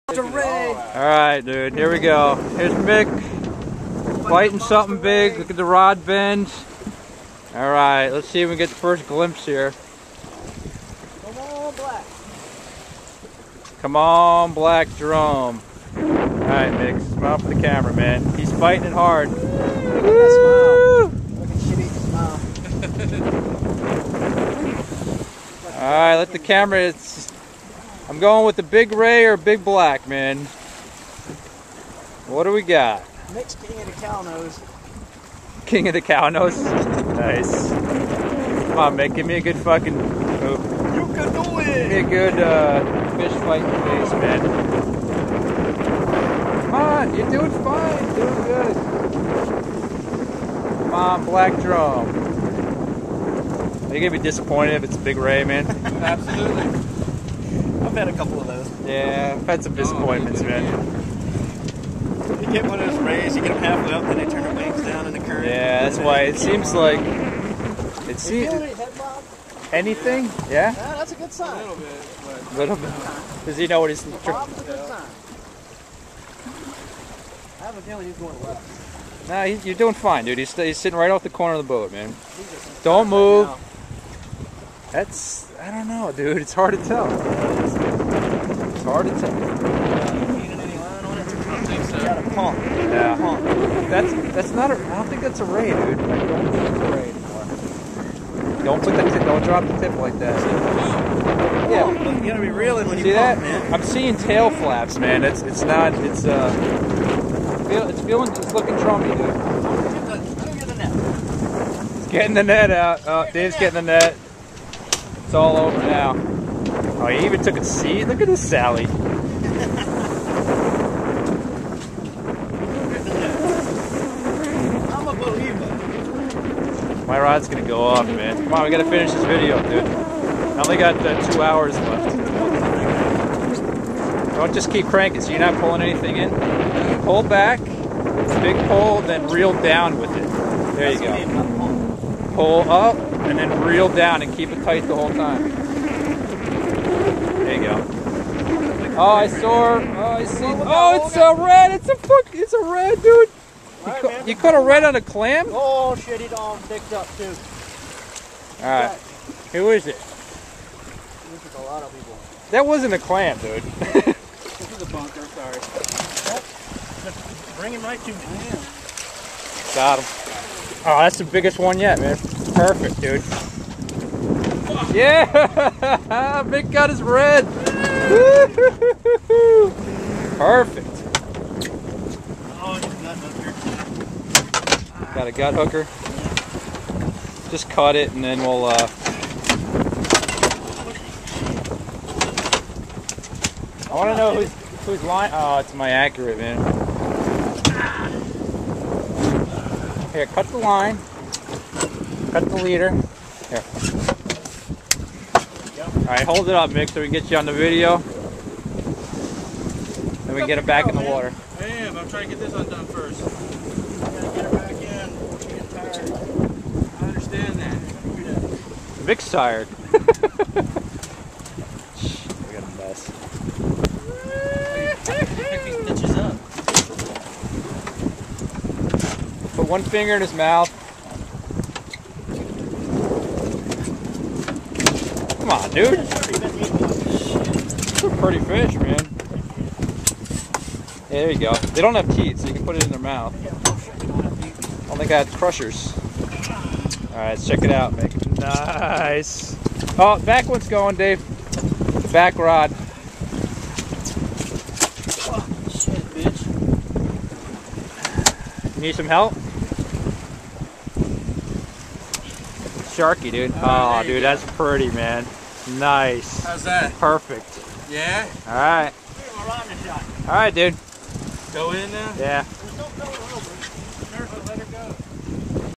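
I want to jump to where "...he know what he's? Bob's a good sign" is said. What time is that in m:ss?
1:13.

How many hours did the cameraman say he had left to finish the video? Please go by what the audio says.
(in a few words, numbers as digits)
2.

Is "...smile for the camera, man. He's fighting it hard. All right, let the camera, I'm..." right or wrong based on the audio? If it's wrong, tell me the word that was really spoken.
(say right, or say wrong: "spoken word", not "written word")
right.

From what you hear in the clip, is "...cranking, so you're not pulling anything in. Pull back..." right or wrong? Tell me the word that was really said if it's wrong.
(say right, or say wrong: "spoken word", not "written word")
right.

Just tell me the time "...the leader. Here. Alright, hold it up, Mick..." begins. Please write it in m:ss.
3:22.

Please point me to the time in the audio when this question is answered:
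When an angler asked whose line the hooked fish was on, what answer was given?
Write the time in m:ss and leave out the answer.
3:15.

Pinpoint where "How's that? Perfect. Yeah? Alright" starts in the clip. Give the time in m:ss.
4:26.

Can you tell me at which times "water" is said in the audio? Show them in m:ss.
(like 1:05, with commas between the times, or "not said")
3:31.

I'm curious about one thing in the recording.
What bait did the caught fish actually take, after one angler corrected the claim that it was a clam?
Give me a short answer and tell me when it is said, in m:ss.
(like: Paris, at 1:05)
Bunker, at 2:44.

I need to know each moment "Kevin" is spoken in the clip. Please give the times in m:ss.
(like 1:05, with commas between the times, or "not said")
not said.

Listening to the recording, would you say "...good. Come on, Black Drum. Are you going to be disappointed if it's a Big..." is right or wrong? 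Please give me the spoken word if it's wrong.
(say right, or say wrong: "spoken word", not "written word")
right.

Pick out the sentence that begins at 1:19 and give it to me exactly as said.
Nah, he, you're doing fine, dude.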